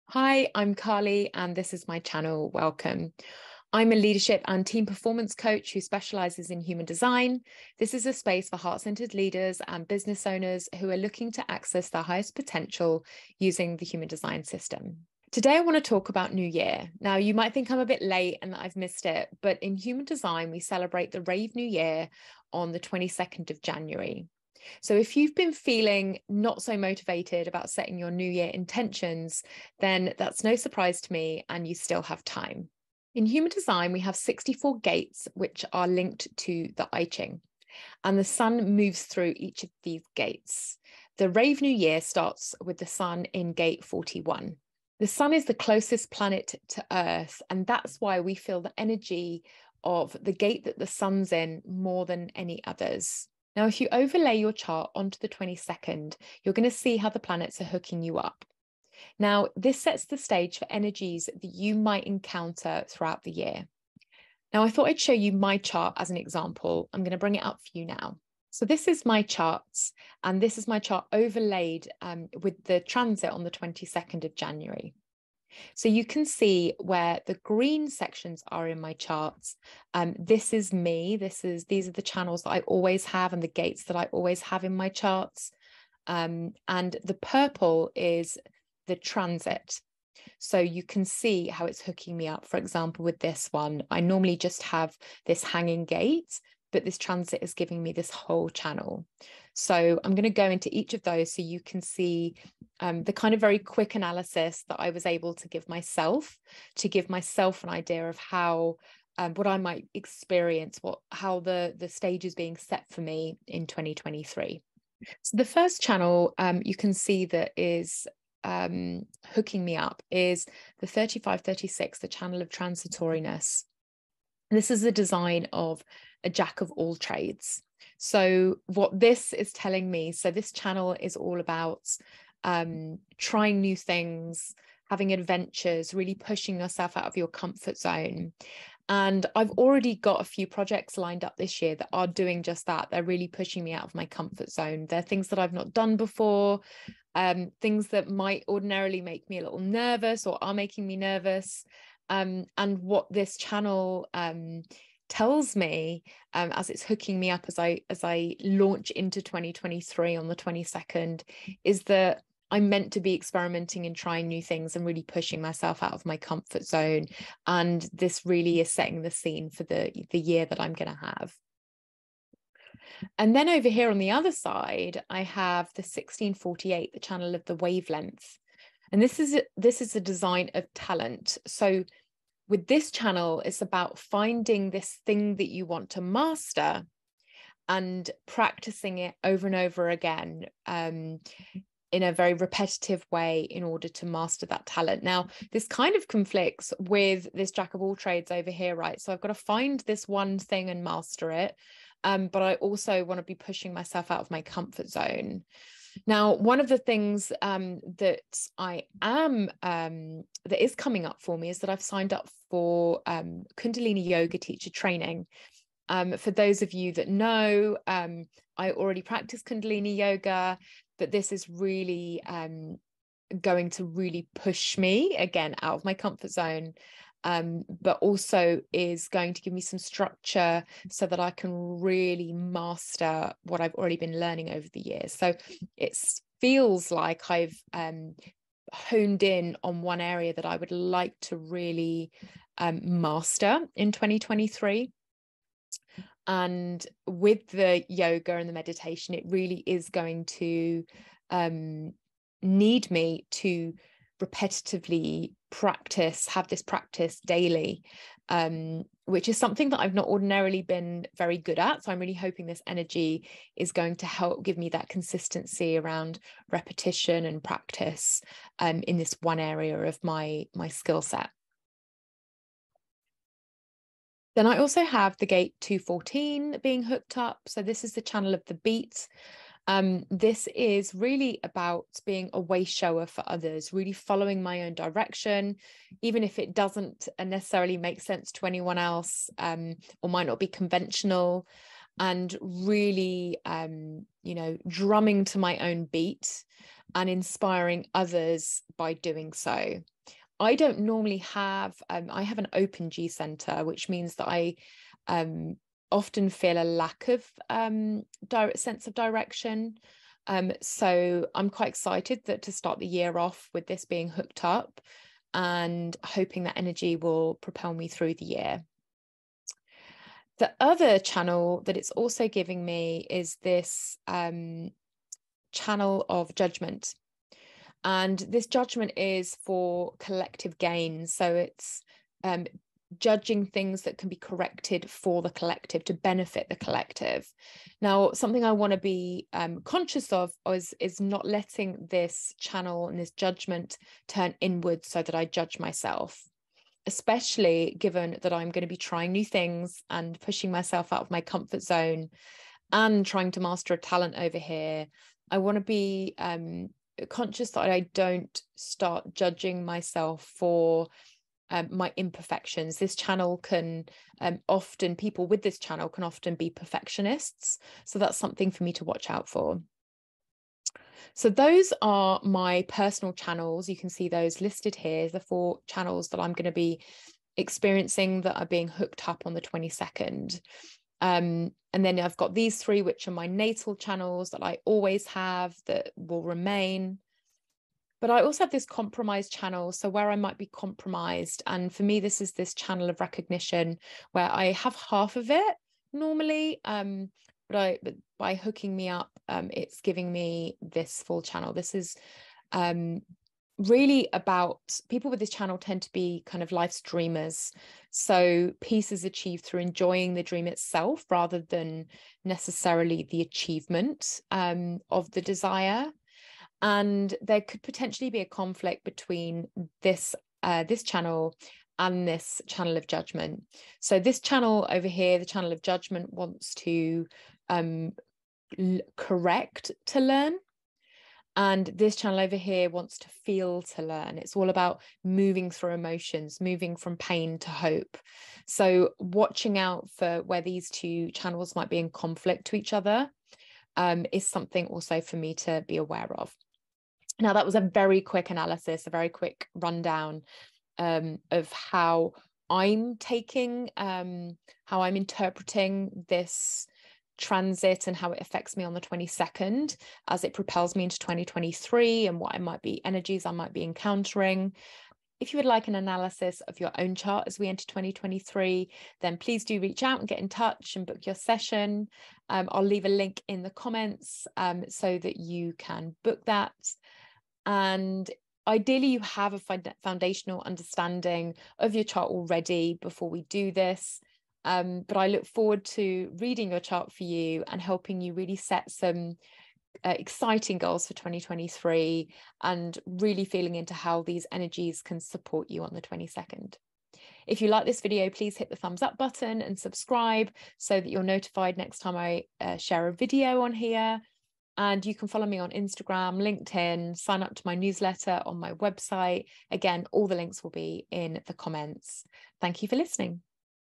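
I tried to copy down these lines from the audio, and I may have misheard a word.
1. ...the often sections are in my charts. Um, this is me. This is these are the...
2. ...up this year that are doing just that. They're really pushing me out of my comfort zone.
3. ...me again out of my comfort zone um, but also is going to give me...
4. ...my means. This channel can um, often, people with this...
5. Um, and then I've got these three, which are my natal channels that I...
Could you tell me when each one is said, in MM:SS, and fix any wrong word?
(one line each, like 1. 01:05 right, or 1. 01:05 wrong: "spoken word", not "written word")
1. 01:17 wrong: "green", not "often"
2. 02:21 right
3. 03:44 right
4. 06:01 wrong: "imperfections", not "means"
5. 06:21 right.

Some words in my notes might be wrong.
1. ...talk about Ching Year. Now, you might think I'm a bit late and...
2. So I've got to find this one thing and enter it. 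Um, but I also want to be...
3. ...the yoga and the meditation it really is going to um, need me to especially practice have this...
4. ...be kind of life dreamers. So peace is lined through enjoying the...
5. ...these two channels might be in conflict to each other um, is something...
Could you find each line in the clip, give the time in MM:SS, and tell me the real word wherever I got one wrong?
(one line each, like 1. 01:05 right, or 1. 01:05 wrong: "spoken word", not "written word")
1. 00:15 wrong: "New", not "Ching"
2. 03:18 wrong: "master", not "enter"
3. 04:07 wrong: "repetitively", not "especially"
4. 06:45 wrong: "achieved", not "lined"
5. 07:20 right.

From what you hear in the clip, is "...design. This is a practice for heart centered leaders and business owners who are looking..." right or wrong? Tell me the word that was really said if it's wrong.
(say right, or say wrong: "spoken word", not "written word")
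wrong: "space", not "practice".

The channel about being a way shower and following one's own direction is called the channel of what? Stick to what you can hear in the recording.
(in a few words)
the beat.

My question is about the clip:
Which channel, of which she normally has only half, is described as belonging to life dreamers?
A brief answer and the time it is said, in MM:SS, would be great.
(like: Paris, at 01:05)
channel of recognition, at 06:32.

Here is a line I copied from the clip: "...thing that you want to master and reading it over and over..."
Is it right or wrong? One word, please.
wrong.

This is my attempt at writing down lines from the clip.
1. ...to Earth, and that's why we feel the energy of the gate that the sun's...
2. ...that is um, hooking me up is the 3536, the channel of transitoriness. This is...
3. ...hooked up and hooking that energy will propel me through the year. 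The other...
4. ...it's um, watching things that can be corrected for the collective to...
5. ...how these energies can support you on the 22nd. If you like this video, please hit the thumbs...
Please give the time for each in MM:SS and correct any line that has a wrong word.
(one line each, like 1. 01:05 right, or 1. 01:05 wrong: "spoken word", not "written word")
1. 00:46 right
2. 01:57 right
3. 05:14 wrong: "hoping", not "hooking"
4. 05:31 wrong: "judging", not "watching"
5. 08:13 right.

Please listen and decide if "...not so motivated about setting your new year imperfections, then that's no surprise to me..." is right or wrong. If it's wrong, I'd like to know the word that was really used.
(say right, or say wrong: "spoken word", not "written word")
wrong: "intentions", not "imperfections".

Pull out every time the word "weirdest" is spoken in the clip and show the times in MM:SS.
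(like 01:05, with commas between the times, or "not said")
not said.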